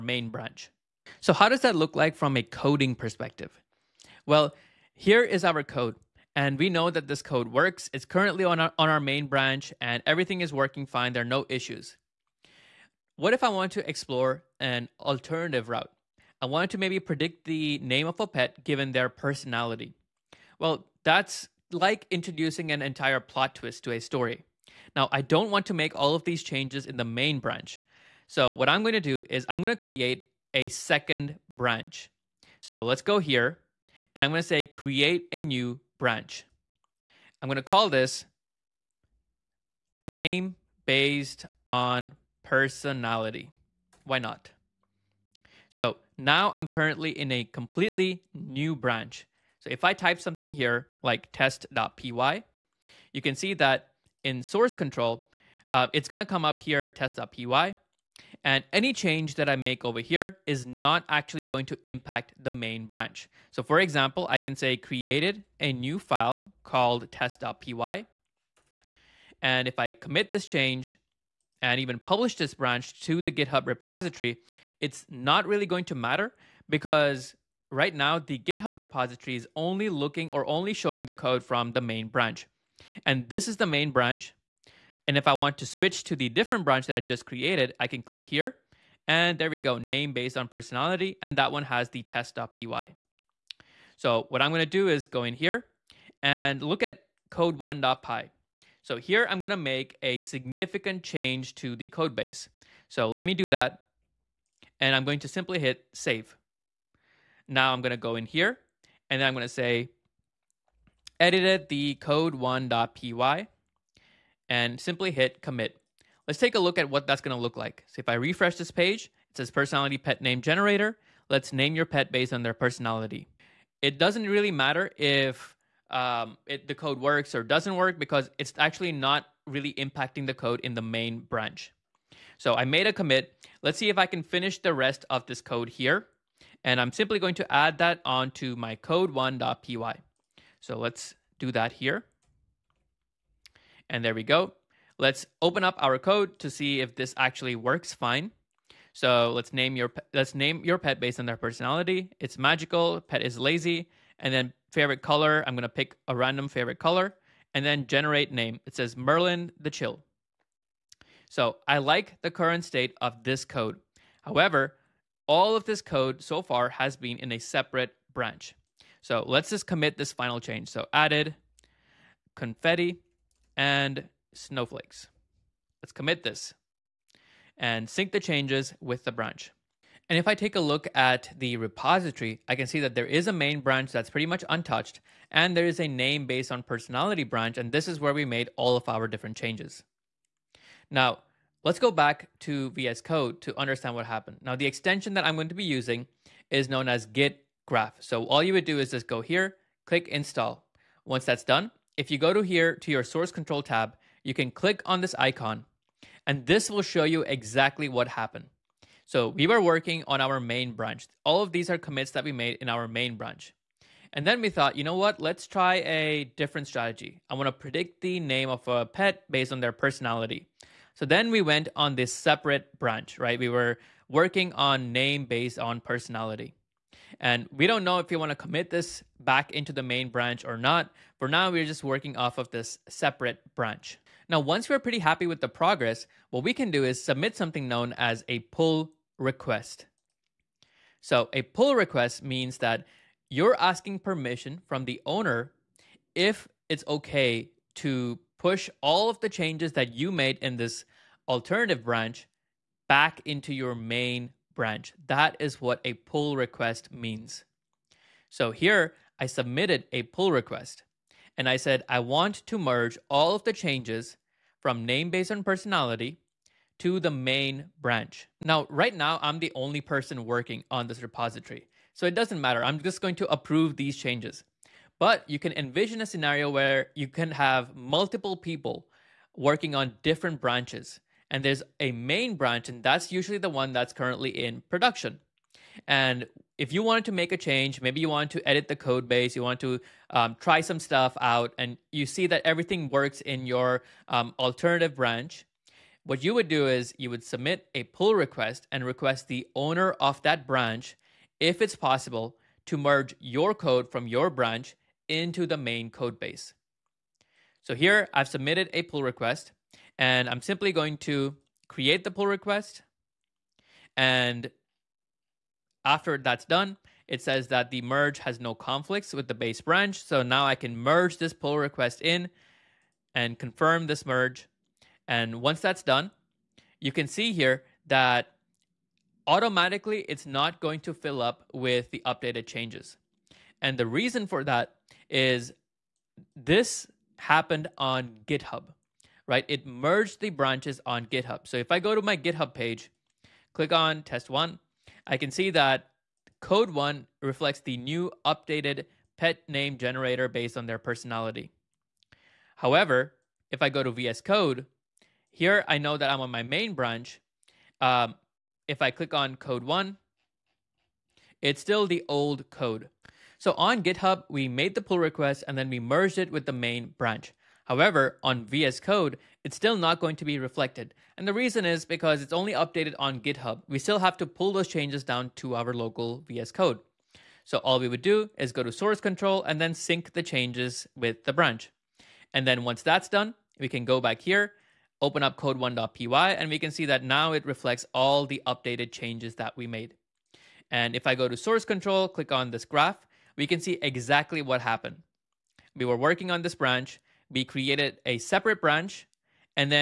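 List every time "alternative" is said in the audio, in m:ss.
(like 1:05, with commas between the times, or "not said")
0:14, 4:11, 4:54.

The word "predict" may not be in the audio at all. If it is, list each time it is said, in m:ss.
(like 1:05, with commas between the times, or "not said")
0:16, 3:37.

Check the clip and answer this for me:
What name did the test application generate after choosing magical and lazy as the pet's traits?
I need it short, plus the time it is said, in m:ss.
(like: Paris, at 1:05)
Merlin the Chill, at 2:38.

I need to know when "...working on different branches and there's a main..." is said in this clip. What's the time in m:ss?
4:39.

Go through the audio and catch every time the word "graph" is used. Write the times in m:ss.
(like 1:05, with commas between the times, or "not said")
3:17, 6:32.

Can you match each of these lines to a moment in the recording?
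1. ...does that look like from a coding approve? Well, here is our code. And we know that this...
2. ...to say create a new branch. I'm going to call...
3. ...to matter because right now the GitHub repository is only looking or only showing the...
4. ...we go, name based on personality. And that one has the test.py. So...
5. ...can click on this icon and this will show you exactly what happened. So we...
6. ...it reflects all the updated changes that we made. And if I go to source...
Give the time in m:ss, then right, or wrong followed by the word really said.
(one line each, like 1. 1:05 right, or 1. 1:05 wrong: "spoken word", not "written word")
1. 0:01 wrong: "perspective", not "approve"
2. 0:34 right
3. 1:15 right
4. 1:29 right
5. 3:24 right
6. 6:27 right.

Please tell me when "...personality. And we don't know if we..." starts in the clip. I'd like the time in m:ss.
3:45.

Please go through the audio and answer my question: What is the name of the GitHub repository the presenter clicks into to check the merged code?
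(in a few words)
test one.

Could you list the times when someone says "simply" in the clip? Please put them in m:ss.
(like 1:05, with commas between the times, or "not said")
1:45, 1:54, 2:16, 5:10.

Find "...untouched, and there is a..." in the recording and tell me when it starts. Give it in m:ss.
3:04.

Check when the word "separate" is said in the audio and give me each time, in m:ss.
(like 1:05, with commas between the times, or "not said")
2:47, 3:42, 3:52, 6:38.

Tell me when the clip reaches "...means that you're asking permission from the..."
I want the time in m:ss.
4:02.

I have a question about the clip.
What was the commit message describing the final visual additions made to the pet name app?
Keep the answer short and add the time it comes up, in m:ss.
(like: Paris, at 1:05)
added confetti and snowflakes, at 2:50.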